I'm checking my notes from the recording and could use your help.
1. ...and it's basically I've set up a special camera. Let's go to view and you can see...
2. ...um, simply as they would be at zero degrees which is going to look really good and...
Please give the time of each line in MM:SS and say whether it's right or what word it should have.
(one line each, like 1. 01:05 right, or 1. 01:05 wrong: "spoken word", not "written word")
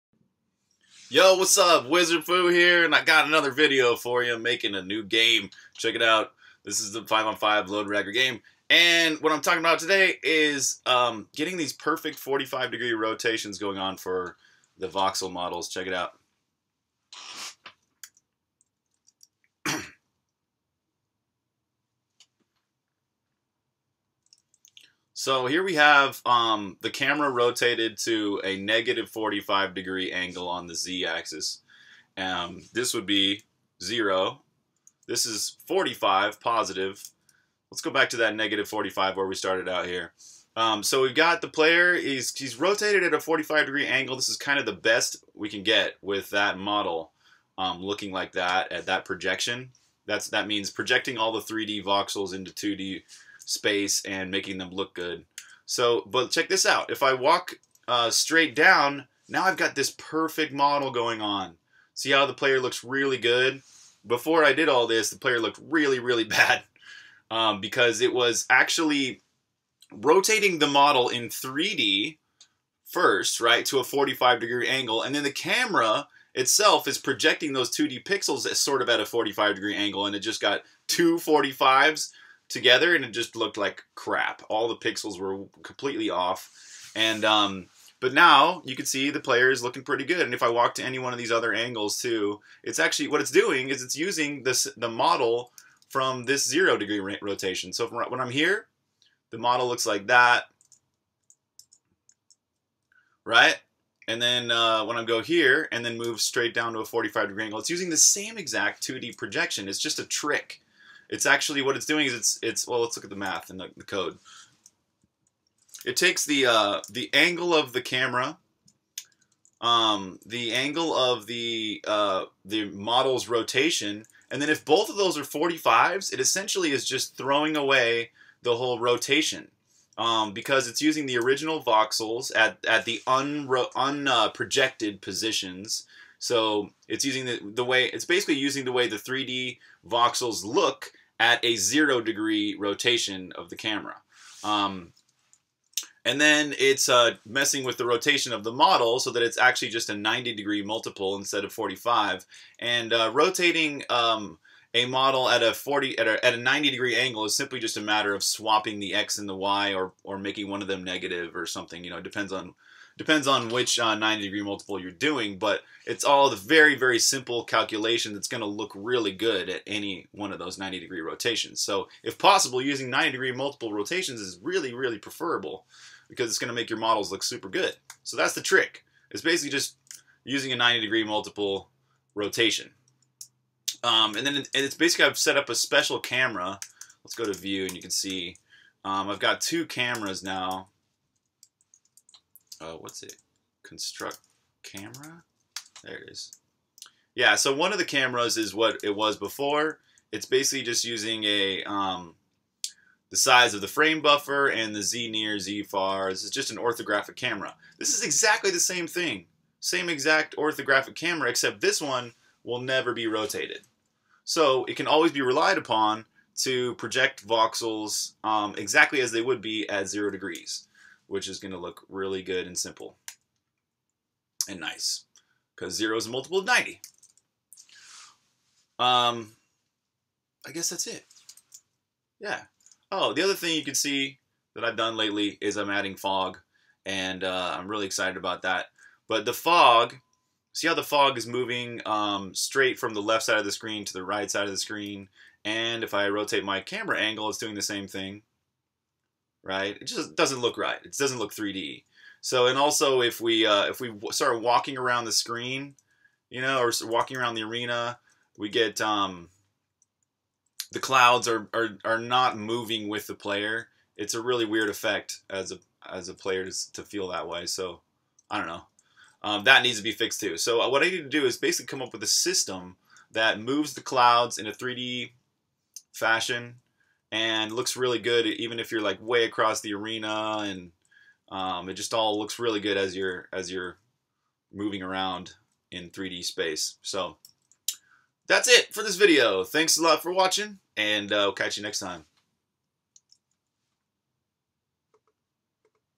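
1. 03:04 right
2. 03:38 wrong: "exactly", not "simply".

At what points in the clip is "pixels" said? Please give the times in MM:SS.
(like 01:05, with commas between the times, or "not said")
01:18, 01:24.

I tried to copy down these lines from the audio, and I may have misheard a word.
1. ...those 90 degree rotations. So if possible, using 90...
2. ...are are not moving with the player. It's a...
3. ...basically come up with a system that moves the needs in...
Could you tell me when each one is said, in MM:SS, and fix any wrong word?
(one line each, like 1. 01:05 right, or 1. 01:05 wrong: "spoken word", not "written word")
1. 02:50 right
2. 04:21 right
3. 04:31 wrong: "clouds", not "needs".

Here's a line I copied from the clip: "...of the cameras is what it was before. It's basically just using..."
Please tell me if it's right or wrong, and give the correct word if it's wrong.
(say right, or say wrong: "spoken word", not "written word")
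right.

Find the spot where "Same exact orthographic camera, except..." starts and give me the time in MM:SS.
03:29.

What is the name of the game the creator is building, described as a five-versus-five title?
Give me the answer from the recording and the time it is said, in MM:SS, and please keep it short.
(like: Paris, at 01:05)
Loderagger, at 00:07.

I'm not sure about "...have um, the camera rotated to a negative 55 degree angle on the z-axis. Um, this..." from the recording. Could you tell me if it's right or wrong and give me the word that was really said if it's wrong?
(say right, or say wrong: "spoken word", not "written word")
wrong: "45", not "55".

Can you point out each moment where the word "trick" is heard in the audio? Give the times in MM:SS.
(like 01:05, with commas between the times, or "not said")
01:50, 02:58.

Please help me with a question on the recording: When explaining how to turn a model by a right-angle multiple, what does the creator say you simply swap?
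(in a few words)
the x and the y.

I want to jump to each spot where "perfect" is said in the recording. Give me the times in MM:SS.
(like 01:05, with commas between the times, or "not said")
00:11, 00:59.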